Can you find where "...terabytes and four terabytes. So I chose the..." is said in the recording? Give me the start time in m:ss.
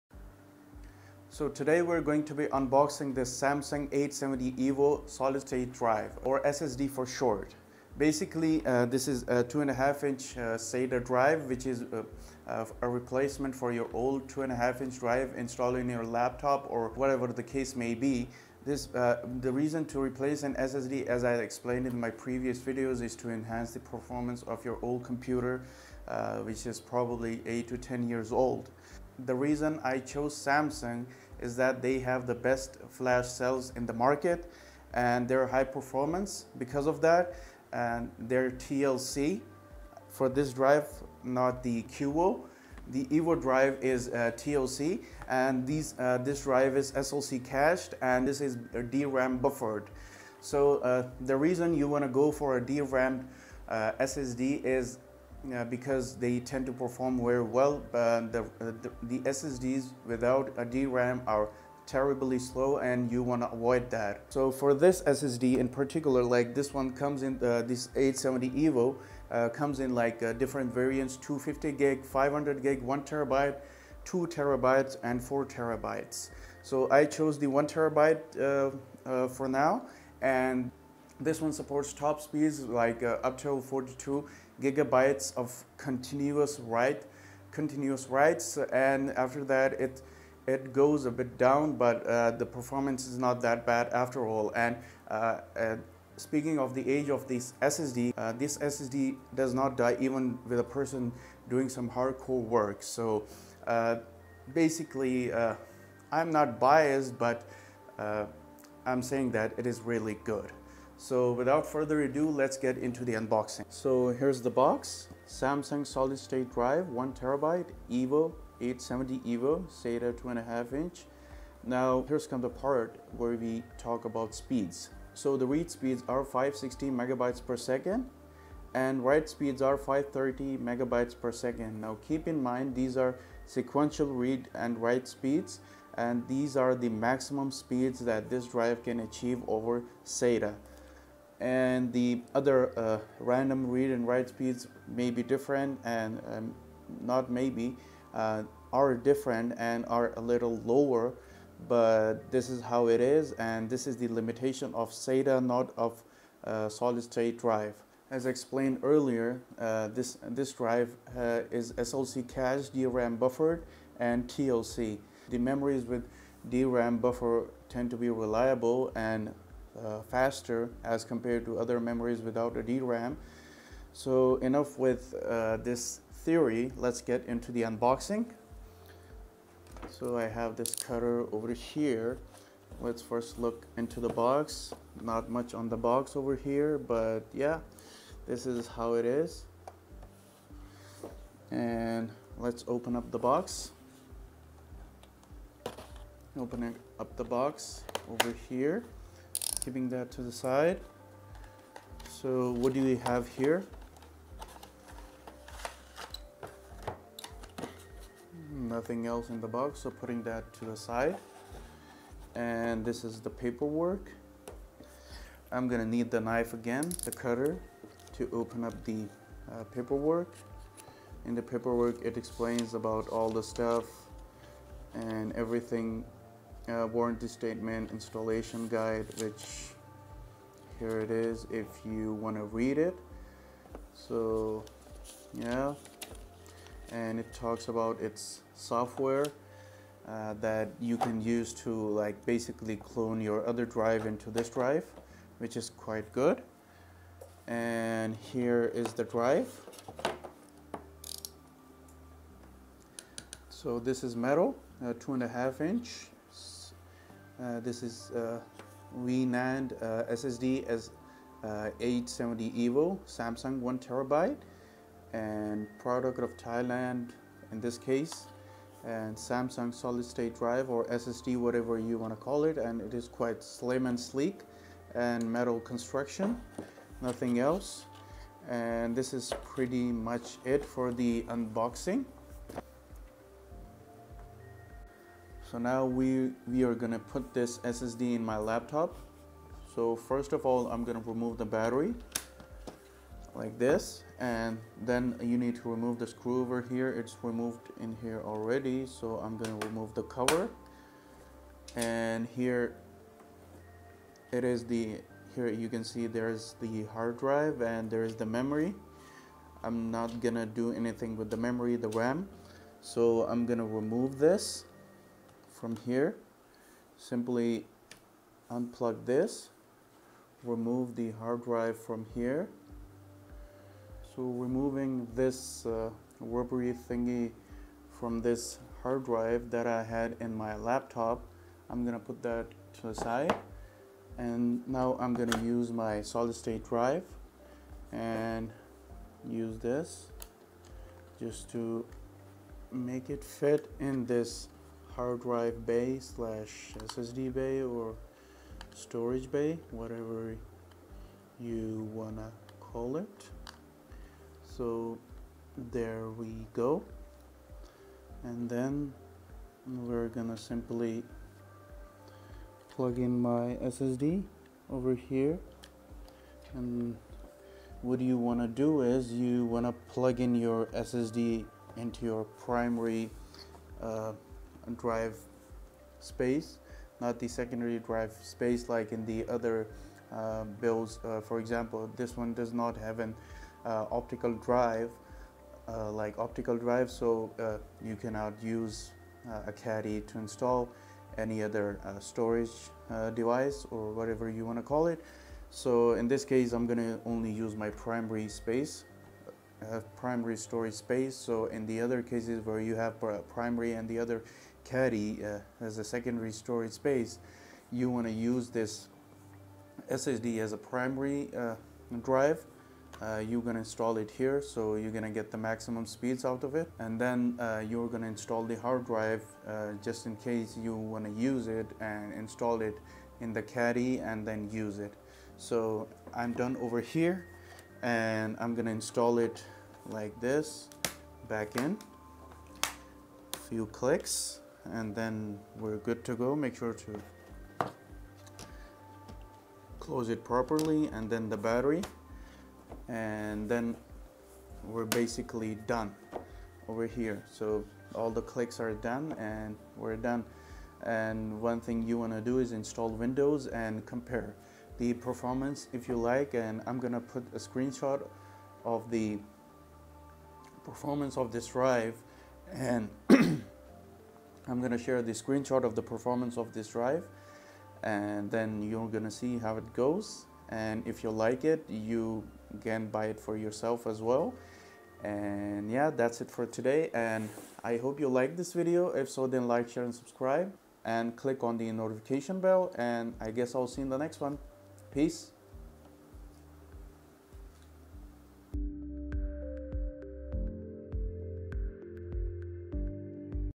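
1:14.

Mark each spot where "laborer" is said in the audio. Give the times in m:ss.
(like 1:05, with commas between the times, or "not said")
not said.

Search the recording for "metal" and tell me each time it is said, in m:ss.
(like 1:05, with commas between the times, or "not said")
4:14, 4:35.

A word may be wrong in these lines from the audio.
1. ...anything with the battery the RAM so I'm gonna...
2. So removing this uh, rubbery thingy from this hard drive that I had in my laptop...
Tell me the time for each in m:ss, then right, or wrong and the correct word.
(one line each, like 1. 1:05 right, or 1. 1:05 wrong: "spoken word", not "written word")
1. 5:10 wrong: "memory", not "battery"
2. 5:24 right.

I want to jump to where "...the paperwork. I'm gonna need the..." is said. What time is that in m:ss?
3:33.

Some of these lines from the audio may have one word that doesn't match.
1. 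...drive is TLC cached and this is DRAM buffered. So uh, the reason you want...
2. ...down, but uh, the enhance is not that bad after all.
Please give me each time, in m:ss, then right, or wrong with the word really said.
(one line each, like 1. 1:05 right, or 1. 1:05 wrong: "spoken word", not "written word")
1. 0:46 wrong: "SLC", not "TLC"
2. 1:31 wrong: "performance", not "enhance".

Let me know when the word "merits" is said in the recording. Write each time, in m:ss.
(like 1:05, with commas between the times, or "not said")
not said.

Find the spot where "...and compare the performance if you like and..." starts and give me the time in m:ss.
7:33.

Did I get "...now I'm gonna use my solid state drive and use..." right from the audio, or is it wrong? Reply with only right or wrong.
right.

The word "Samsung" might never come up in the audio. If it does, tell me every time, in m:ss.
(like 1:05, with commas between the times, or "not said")
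0:03, 0:30, 1:55, 4:23, 4:29.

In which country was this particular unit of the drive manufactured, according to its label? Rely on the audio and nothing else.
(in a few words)
Thailand.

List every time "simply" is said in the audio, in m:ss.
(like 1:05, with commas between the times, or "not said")
5:16, 6:00.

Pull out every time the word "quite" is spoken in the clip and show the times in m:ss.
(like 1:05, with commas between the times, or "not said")
4:05, 4:33.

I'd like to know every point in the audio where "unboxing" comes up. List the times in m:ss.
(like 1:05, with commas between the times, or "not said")
0:02, 1:53, 2:57, 4:41.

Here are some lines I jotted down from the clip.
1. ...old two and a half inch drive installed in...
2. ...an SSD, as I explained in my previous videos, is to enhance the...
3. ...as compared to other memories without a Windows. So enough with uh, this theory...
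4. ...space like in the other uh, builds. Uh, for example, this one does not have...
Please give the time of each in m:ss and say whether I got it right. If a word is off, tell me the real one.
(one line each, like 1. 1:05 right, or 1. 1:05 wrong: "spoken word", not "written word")
1. 0:13 right
2. 0:20 right
3. 2:50 wrong: "DRAM", not "Windows"
4. 6:18 right.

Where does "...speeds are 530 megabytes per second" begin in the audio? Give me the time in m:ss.
2:09.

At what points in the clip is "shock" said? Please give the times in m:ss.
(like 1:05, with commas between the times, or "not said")
not said.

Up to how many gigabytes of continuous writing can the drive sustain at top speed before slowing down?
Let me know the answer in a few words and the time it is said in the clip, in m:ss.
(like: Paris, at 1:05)
42 gigabytes, at 1:23.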